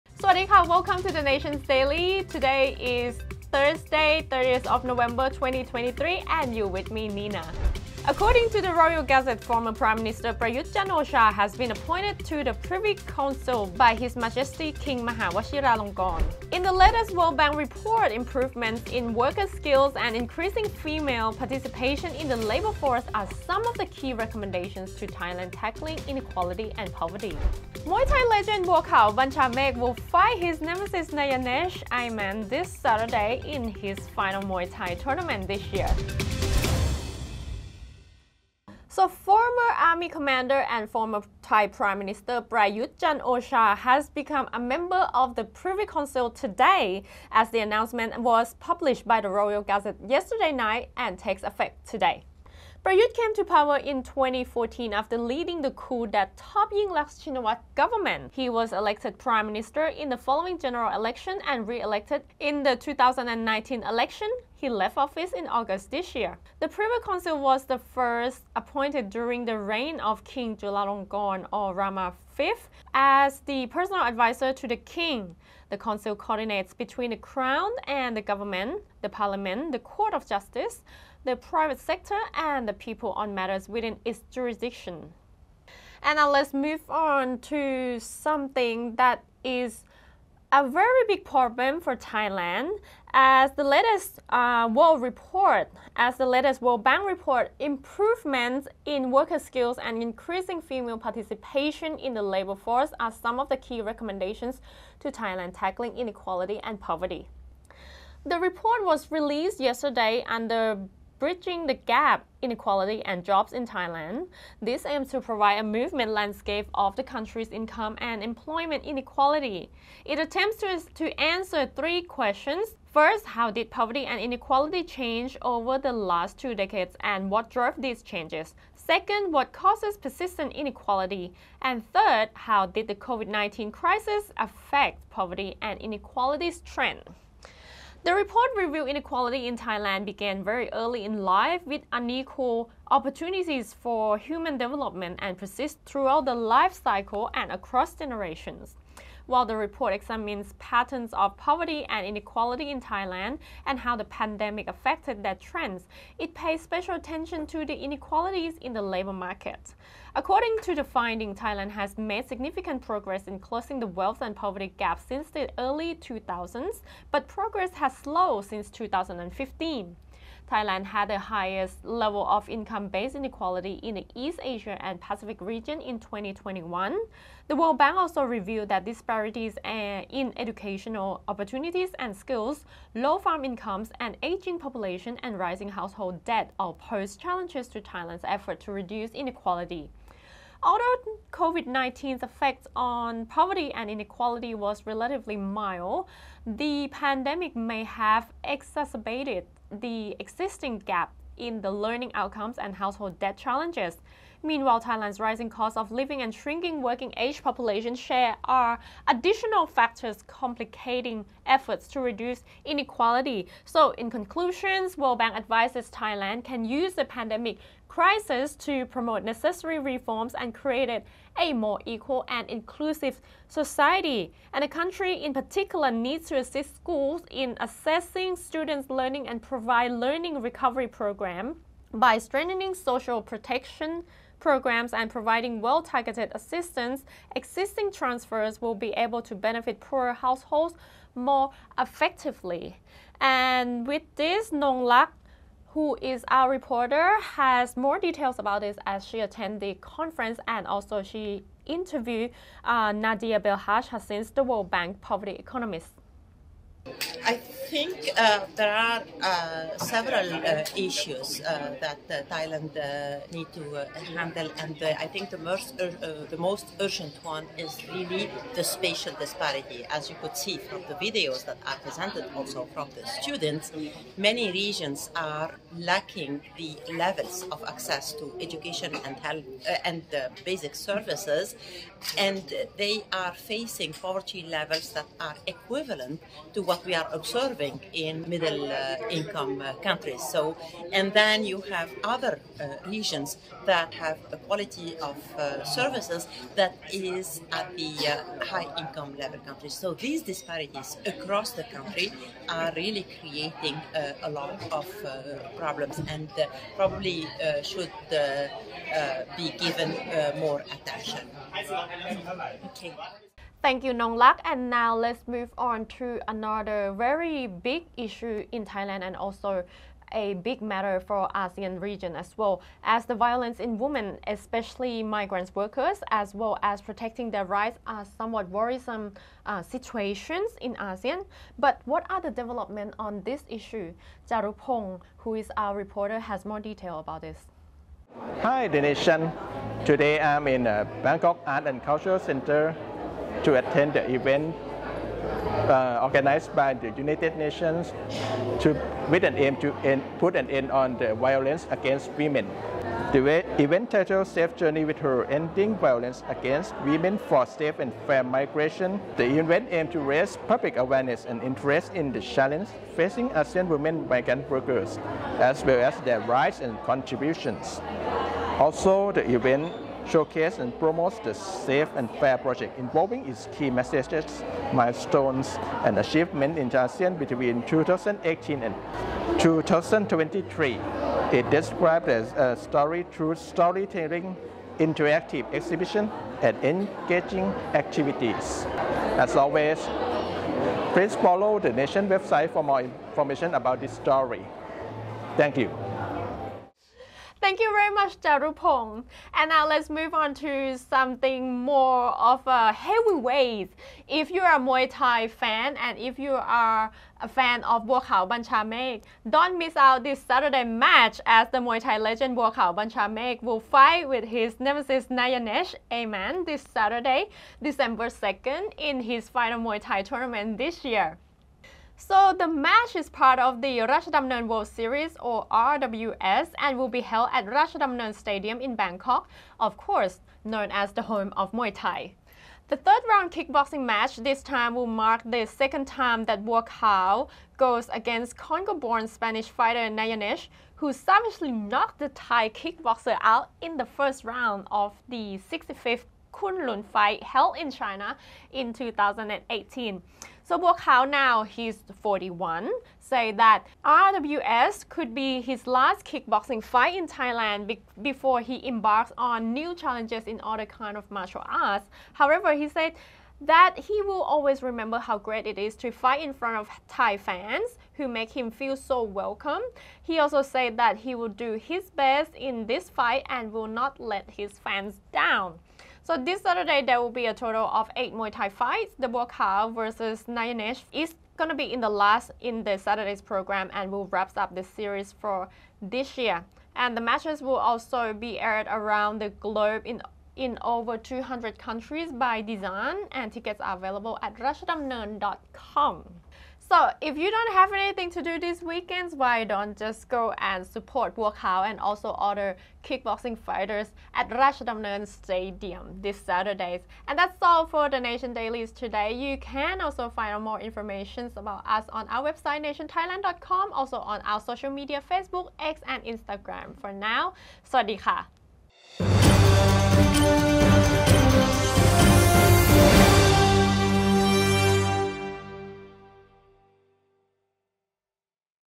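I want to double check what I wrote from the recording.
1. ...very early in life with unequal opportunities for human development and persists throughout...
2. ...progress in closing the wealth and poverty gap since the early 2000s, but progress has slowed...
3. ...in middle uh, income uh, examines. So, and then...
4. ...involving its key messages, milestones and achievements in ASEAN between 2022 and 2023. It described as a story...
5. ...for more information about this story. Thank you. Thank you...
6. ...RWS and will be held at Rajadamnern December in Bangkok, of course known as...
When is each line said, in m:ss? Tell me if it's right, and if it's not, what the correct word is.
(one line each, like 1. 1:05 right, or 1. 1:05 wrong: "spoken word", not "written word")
1. 2:20 right
2. 2:42 right
3. 4:47 wrong: "countries", not "examines"
4. 6:12 wrong: "2018", not "2022"
5. 6:32 right
6. 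7:05 wrong: "Stadium", not "December".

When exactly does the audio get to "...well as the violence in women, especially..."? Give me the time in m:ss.
5:22.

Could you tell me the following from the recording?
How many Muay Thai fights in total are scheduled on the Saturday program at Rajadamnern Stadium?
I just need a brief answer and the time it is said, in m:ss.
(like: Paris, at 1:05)
8, at 7:57.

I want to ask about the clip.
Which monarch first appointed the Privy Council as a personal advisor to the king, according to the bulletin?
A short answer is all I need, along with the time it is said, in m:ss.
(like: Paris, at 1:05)
King Chulalongkorn, at 1:10.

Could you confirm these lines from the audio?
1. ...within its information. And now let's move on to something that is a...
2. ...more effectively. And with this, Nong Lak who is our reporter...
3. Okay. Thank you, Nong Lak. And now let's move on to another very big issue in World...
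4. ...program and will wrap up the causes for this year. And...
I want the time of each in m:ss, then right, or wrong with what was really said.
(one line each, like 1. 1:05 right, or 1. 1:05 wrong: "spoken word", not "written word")
1. 1:23 wrong: "jurisdiction", not "information"
2. 4:01 right
3. 5:12 wrong: "Thailand", not "World"
4. 8:03 wrong: "series", not "causes".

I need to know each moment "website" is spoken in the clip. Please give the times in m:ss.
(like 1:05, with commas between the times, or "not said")
6:32, 8:32.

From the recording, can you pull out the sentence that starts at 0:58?
He was elected prime minister in the following general election and re-elected in the 2019 election.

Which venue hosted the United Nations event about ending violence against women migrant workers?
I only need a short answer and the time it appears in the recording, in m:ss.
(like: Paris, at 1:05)
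Bangkok Art and Cultural Center, at 5:41.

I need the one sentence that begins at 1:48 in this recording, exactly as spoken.
The report was released yesterday under Bridging the Gap Inequality and Jobs in Thailand.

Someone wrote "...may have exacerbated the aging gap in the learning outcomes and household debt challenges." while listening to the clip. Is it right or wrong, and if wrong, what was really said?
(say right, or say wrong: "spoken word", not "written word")
wrong: "existing", not "aging".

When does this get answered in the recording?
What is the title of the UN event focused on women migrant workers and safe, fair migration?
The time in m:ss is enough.
5:54.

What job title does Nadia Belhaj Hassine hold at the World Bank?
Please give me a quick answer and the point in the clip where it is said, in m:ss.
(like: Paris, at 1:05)
Poverty economist, at 4:14.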